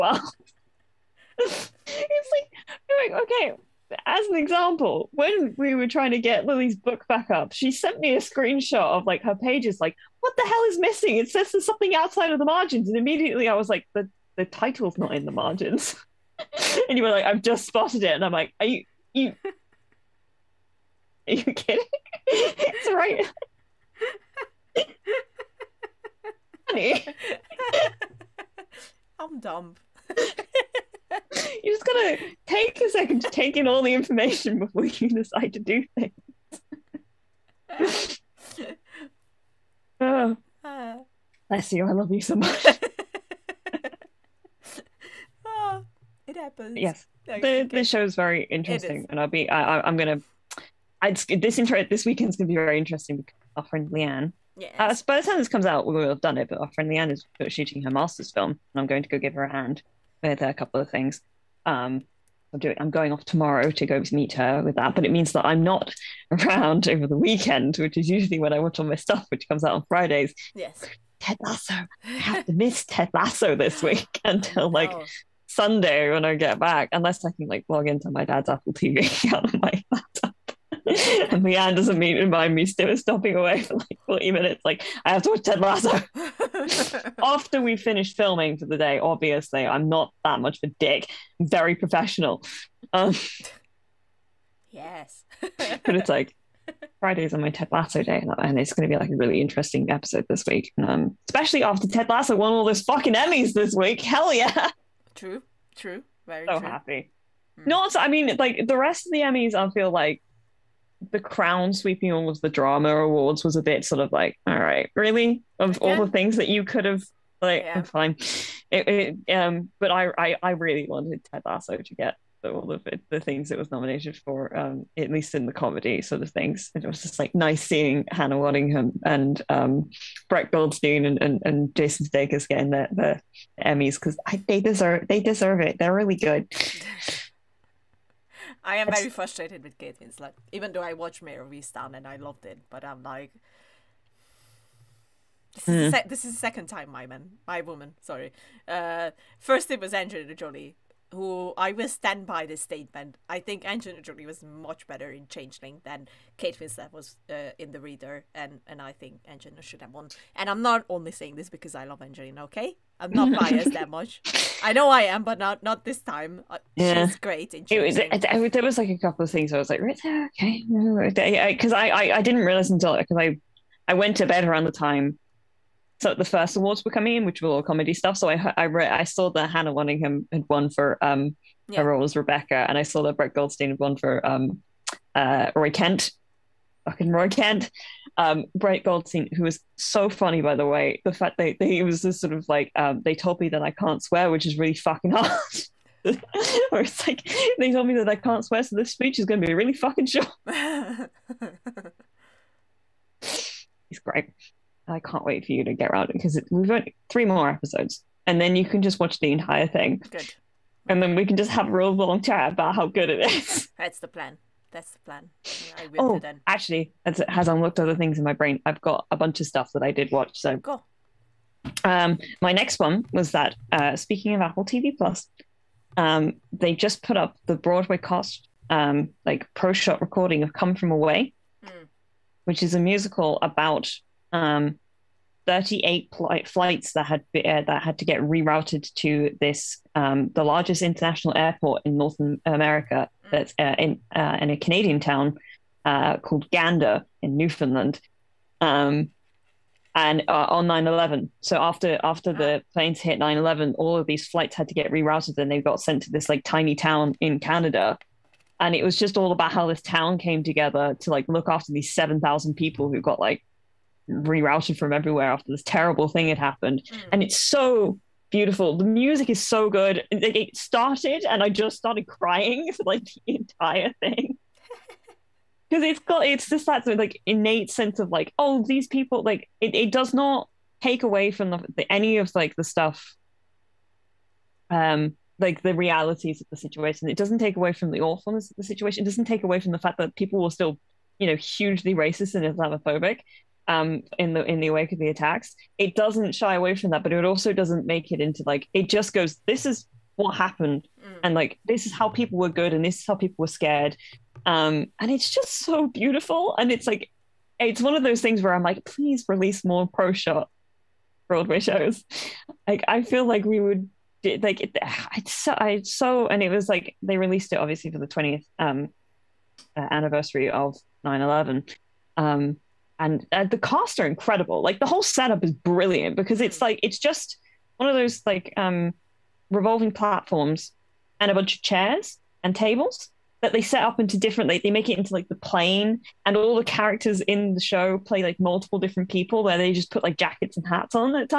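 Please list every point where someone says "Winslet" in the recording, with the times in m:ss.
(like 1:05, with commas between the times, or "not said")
2:19, 2:36.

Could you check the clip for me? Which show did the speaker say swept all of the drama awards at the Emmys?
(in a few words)
The Crown.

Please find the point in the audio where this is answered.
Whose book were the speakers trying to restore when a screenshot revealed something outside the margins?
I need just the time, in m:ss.
0:06.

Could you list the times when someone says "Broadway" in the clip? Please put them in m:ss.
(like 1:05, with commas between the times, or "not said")
3:47, 5:11.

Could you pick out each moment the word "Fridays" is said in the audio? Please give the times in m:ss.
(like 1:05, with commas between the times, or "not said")
1:09, 1:36.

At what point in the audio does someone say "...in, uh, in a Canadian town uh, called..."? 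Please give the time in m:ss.
4:03.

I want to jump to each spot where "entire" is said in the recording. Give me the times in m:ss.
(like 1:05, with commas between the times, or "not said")
3:29, 4:33.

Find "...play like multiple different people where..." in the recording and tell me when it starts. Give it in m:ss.
5:37.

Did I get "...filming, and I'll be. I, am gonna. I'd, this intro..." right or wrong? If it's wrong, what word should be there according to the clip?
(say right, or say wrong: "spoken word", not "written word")
wrong: "interesting", not "filming".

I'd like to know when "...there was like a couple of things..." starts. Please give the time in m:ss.
2:48.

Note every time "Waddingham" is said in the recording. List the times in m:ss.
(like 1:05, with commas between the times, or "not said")
2:08, 2:59.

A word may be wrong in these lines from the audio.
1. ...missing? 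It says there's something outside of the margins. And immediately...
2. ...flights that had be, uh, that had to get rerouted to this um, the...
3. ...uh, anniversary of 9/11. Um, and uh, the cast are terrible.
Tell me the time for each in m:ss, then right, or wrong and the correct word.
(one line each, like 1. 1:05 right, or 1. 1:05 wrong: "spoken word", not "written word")
1. 0:10 right
2. 3:56 right
3. 5:19 wrong: "incredible", not "terrible".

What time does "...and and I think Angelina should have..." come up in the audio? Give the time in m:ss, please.
2:38.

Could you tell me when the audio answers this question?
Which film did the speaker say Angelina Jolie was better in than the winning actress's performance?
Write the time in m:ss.
2:35.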